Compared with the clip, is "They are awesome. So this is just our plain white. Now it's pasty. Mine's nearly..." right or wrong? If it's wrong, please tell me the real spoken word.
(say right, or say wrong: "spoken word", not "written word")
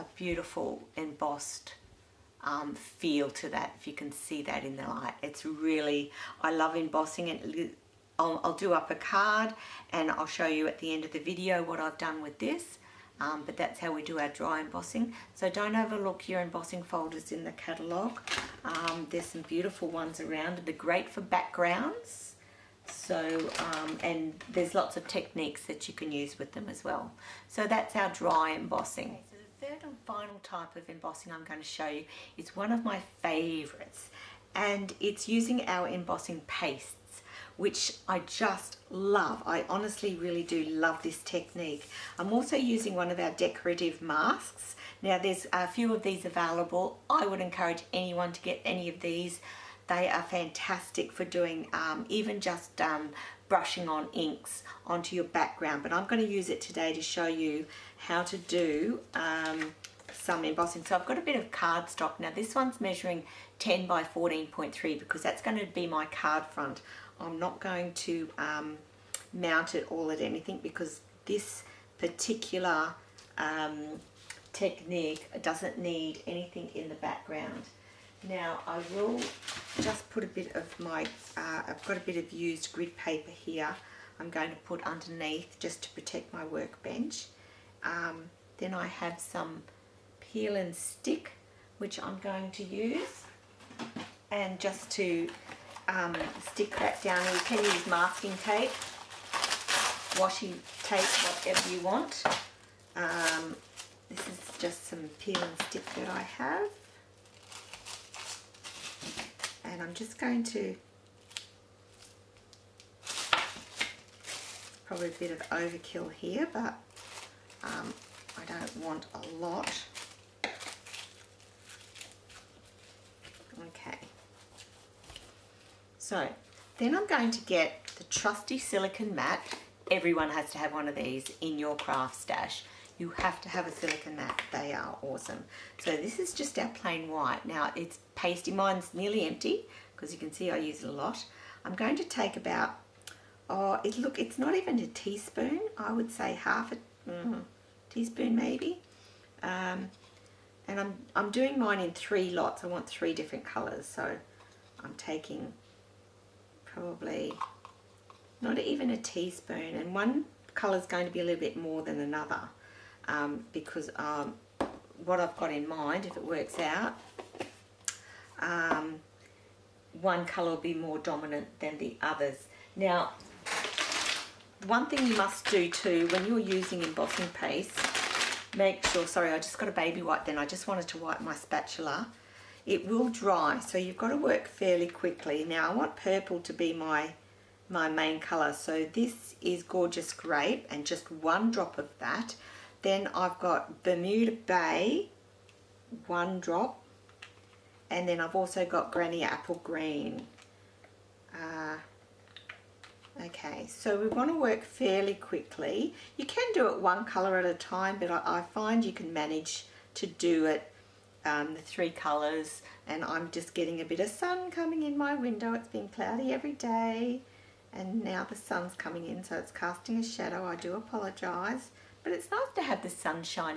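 right.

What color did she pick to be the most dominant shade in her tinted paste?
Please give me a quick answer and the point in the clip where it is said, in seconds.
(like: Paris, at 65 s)
Gorgeous Grape, at 189 s.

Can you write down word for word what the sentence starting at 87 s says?
Um, then I have some peel and stick which I'm going to use and just to um, stick that down.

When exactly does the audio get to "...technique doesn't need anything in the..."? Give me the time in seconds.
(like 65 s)
74 s.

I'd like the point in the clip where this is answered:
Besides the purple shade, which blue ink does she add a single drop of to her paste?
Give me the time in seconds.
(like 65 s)
193 s.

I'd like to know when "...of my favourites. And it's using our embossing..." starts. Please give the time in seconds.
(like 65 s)
32 s.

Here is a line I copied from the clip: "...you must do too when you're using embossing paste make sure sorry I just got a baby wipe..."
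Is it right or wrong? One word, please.
right.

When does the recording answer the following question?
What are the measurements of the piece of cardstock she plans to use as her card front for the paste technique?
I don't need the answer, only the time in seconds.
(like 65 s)
63 s.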